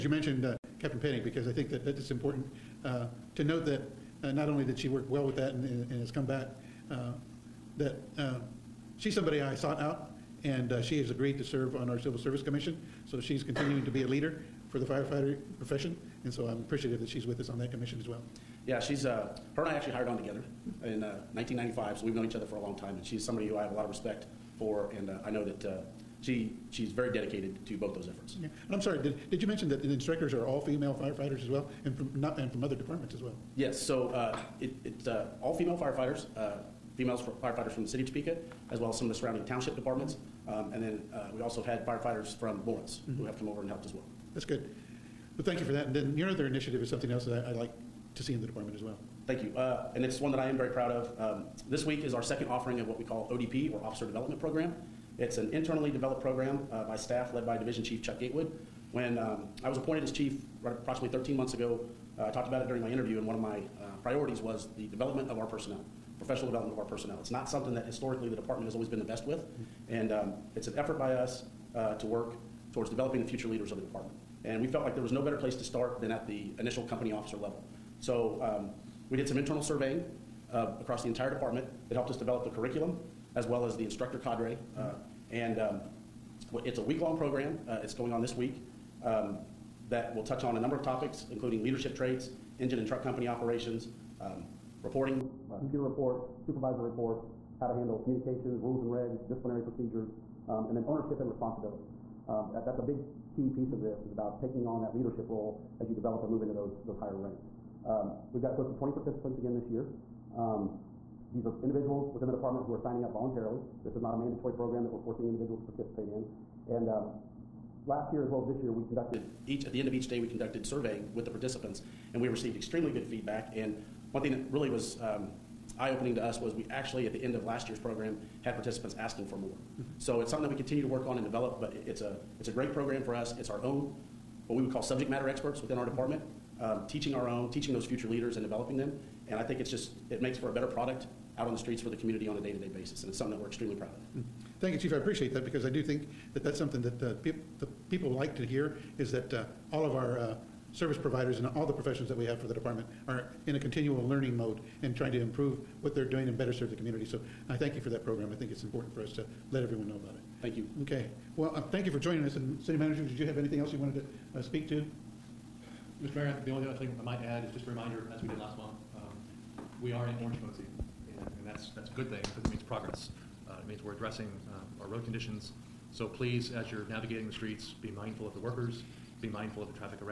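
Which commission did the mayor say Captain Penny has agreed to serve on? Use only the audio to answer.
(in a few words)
Civil Service Commission.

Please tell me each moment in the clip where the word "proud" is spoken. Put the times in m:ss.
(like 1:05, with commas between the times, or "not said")
0:50, 2:23.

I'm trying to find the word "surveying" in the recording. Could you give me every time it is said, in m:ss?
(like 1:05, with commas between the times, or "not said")
1:19, 2:00.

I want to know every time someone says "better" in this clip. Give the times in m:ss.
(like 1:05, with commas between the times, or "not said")
1:15, 2:20, 2:36.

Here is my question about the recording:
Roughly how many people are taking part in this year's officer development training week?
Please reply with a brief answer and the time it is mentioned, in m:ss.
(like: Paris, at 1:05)
close to 20, at 1:48.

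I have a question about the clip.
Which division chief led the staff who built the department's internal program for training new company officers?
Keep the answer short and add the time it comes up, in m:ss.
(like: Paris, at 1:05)
Chuck Gatewood, at 0:58.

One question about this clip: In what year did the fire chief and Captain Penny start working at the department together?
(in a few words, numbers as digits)
1995.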